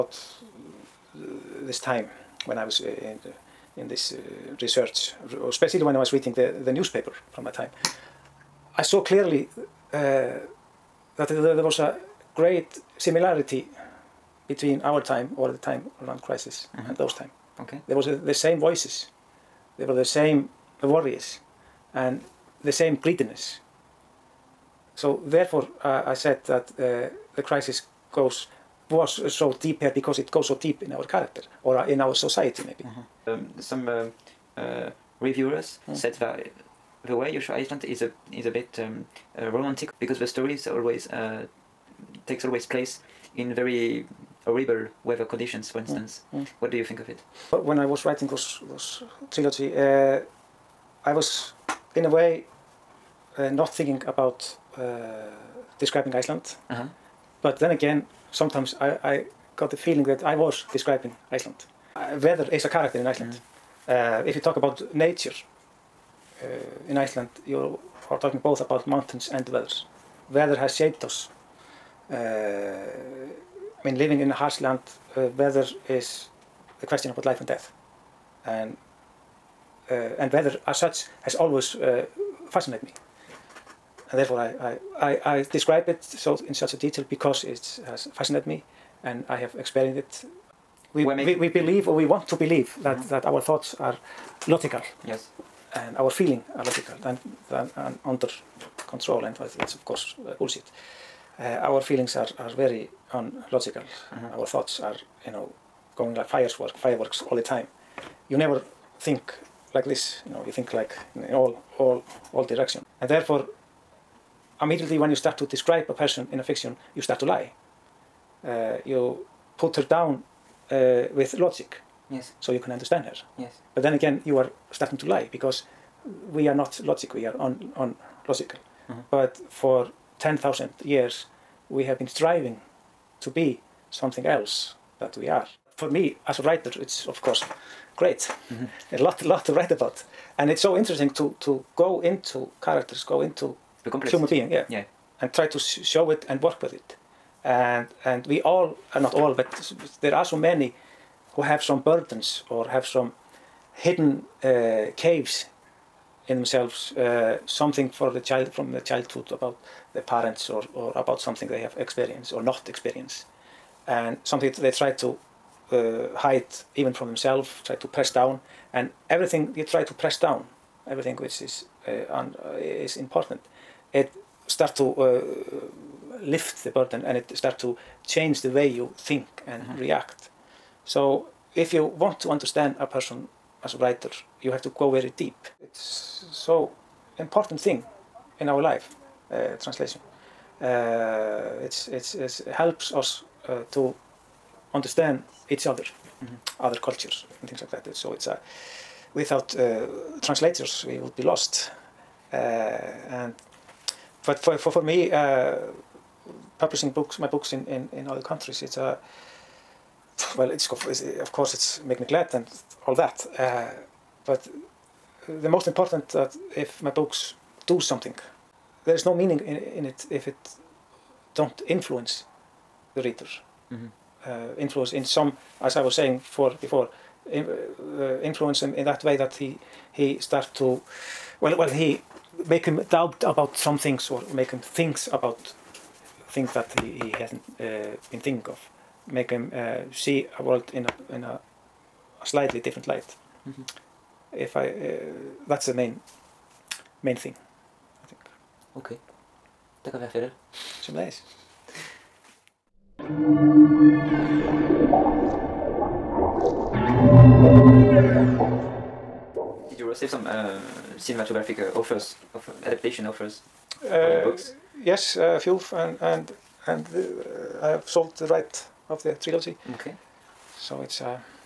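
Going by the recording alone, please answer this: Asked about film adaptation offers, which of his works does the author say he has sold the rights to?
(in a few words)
The trilogy.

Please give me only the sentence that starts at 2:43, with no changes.
And something they try to uh, hide even from themselves, try to press down.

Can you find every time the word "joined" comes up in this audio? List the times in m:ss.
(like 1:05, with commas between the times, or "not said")
not said.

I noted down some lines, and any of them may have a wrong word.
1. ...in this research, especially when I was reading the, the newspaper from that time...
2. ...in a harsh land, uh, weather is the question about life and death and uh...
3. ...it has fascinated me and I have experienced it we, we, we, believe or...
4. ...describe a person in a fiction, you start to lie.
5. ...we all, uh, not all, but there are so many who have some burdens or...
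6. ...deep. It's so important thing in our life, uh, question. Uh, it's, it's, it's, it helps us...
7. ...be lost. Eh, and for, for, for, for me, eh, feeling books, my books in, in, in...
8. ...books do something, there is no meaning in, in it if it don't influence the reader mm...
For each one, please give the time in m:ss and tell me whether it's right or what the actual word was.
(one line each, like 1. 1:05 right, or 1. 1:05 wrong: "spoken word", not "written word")
1. 0:03 right
2. 1:14 right
3. 1:27 right
4. 1:55 right
5. 2:28 right
6. 3:05 wrong: "translation", not "question"
7. 3:21 wrong: "publishing", not "feeling"
8. 3:36 right.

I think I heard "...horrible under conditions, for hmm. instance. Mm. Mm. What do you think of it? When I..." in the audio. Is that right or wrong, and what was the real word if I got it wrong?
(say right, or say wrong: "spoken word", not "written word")
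wrong: "weather", not "under".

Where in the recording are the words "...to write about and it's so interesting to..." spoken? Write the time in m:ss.
2:19.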